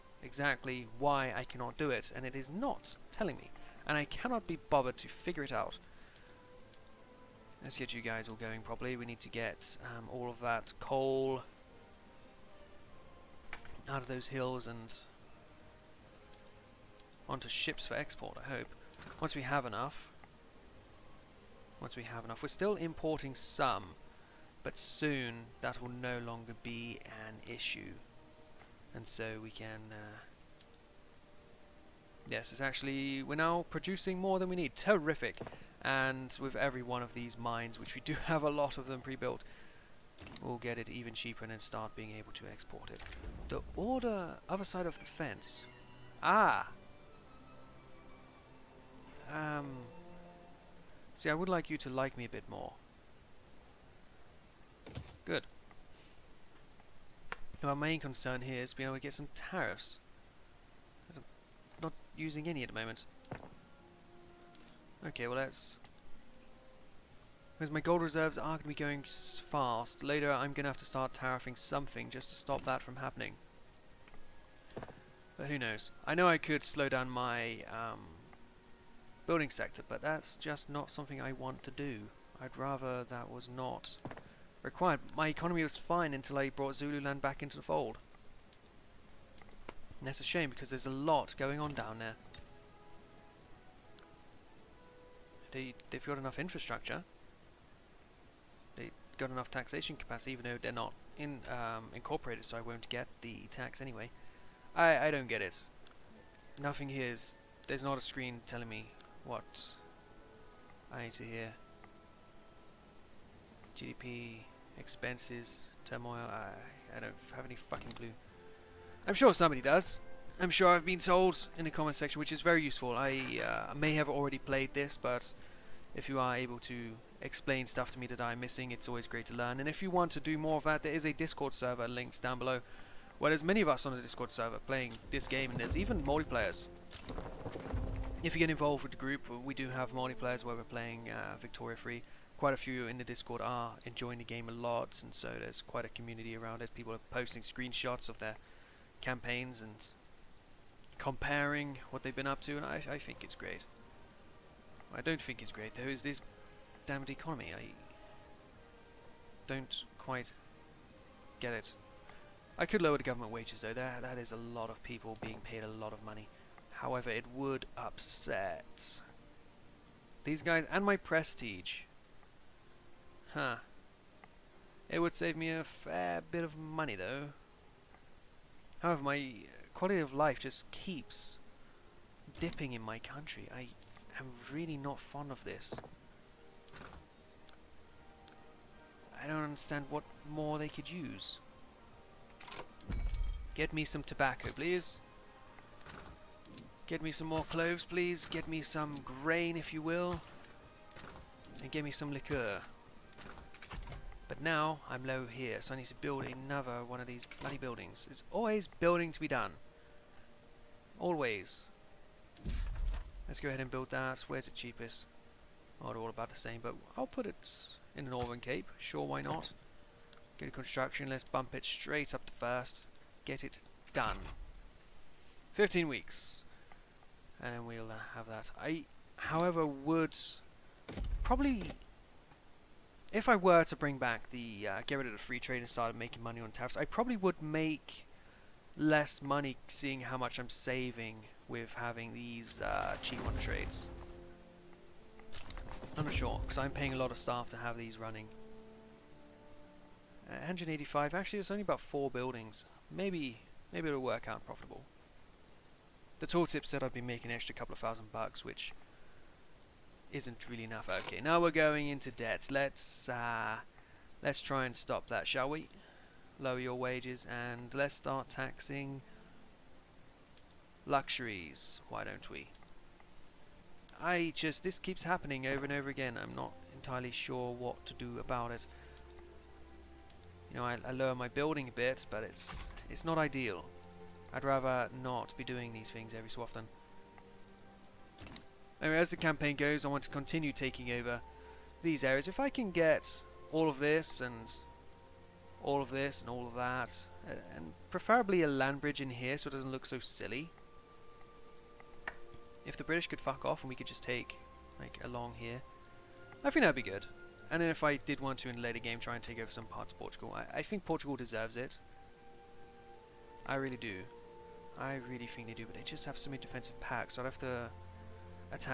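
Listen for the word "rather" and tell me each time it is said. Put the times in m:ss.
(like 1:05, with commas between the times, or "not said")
1:22, 4:44.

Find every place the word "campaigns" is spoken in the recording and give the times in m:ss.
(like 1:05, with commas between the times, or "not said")
2:28, 4:49.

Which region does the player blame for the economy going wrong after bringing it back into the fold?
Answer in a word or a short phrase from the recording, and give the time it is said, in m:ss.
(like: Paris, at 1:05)
Zululand, at 1:26.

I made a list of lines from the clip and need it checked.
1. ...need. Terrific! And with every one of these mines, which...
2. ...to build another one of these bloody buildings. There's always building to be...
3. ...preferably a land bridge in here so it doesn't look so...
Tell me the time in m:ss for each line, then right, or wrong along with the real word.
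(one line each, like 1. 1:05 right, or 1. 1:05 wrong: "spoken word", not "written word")
1. 0:34 right
2. 3:25 right
3. 4:57 right.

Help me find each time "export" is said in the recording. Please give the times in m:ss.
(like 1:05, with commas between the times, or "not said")
0:17, 0:42.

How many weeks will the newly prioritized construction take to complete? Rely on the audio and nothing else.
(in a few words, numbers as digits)
15.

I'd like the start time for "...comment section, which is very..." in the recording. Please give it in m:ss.
2:01.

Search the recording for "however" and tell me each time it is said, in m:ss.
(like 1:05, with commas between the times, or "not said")
2:46, 2:58, 3:49.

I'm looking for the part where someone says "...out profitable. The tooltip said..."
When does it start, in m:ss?
4:14.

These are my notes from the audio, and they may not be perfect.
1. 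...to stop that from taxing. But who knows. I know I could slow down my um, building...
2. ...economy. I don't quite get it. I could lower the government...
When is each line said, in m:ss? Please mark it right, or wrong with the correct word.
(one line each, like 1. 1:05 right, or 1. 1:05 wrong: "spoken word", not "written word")
1. 1:12 wrong: "happening", not "taxing"
2. 2:37 right.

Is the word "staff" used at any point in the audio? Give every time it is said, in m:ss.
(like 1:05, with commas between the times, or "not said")
4:07.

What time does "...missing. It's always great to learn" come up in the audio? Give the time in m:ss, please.
2:08.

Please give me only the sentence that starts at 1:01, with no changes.
I'm not using any at the moment.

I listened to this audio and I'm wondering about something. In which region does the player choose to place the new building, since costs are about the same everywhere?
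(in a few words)
Northern Cape.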